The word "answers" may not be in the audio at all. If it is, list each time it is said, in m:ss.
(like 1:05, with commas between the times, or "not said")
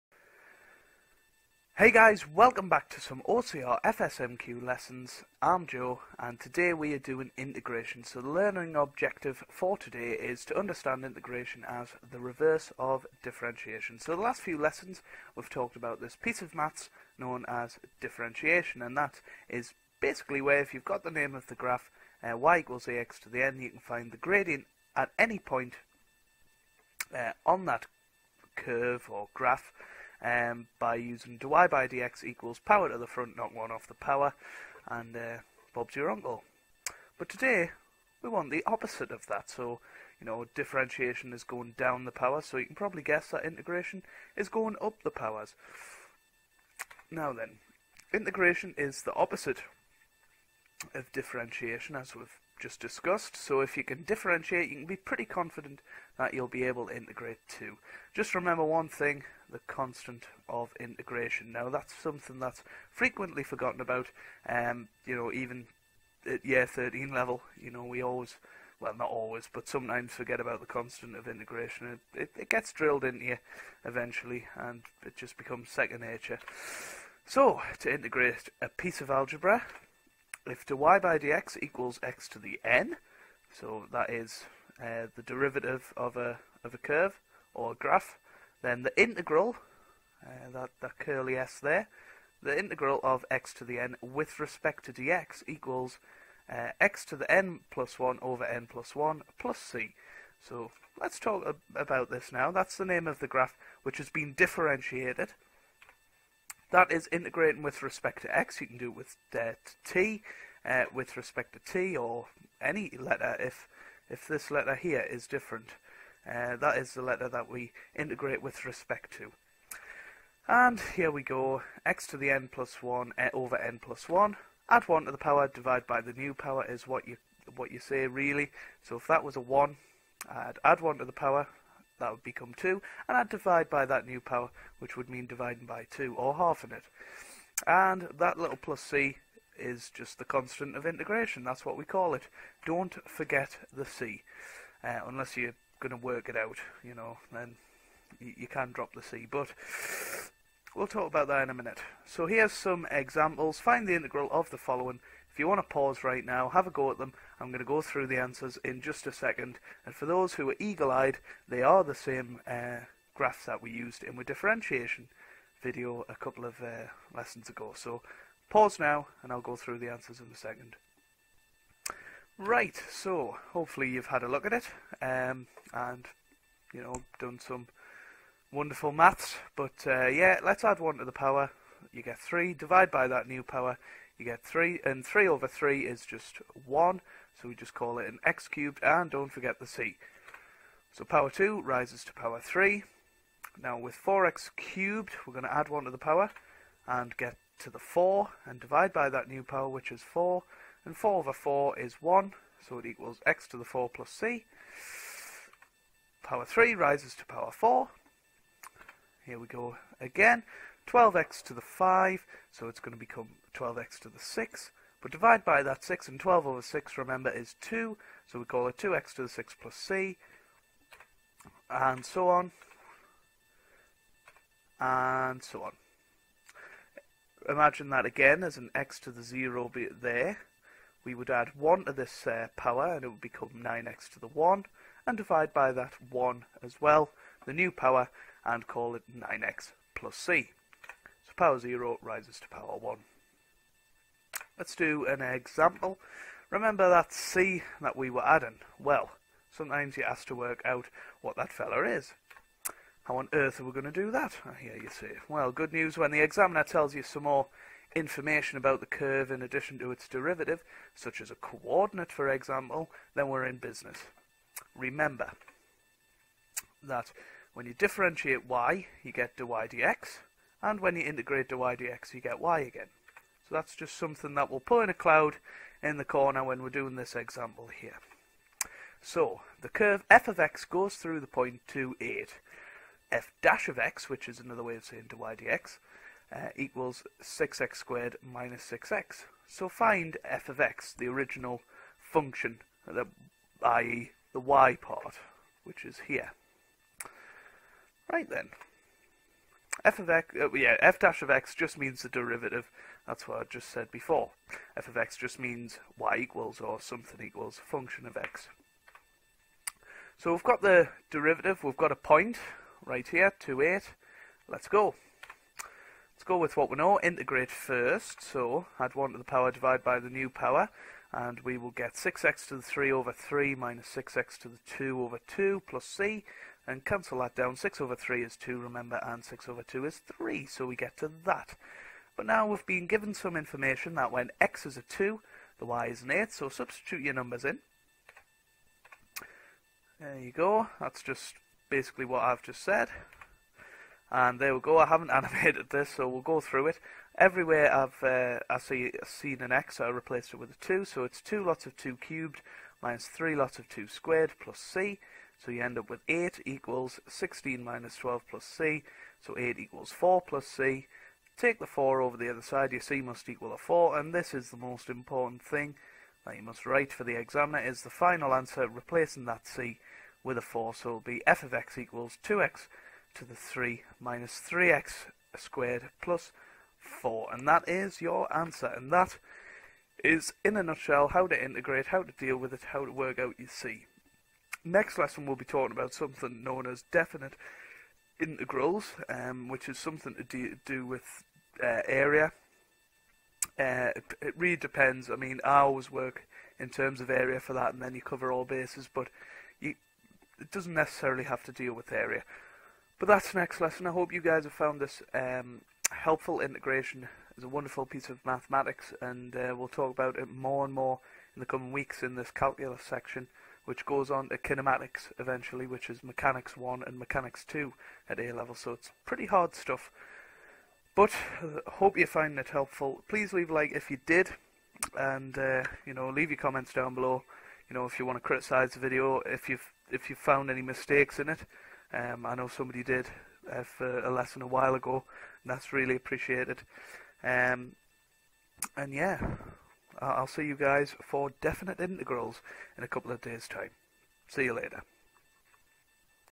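2:38, 2:49, 6:08, 6:18.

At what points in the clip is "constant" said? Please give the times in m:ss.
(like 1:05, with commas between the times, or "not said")
0:59, 1:10, 2:20.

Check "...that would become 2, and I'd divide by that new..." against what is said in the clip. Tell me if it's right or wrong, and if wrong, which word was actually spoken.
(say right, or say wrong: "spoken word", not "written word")
right.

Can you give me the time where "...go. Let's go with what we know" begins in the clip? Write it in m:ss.
5:14.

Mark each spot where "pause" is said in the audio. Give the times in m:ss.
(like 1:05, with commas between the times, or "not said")
2:35, 2:48.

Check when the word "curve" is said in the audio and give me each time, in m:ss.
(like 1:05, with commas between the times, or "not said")
0:28, 1:26, 4:18, 4:39.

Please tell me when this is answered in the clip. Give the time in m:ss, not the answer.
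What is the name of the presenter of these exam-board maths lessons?
0:05.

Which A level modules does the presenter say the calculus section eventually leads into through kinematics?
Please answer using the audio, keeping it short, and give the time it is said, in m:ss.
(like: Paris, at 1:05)
mechanics 1 and mechanics 2, at 6:56.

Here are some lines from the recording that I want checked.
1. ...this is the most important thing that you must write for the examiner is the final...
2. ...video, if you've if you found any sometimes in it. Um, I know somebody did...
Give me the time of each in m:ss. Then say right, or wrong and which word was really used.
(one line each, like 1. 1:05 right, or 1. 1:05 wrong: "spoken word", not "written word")
1. 6:04 right
2. 7:08 wrong: "mistakes", not "sometimes".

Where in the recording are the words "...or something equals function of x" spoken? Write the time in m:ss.
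5:06.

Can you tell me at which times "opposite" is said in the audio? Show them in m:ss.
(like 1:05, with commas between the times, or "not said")
0:38, 0:49.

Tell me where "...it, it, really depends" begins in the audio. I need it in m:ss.
6:33.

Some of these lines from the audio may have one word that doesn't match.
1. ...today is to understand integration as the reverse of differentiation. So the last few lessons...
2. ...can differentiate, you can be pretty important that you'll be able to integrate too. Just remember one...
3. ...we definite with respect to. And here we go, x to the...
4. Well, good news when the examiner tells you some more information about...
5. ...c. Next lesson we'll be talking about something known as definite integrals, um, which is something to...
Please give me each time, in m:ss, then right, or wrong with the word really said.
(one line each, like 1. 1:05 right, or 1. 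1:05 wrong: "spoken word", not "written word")
1. 0:09 right
2. 0:53 wrong: "confident", not "important"
3. 1:57 wrong: "integrate", not "definite"
4. 4:15 right
5. 6:23 right.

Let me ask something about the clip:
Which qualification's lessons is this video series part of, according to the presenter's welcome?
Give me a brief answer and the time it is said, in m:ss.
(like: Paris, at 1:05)
OCR FSMQ, at 0:03.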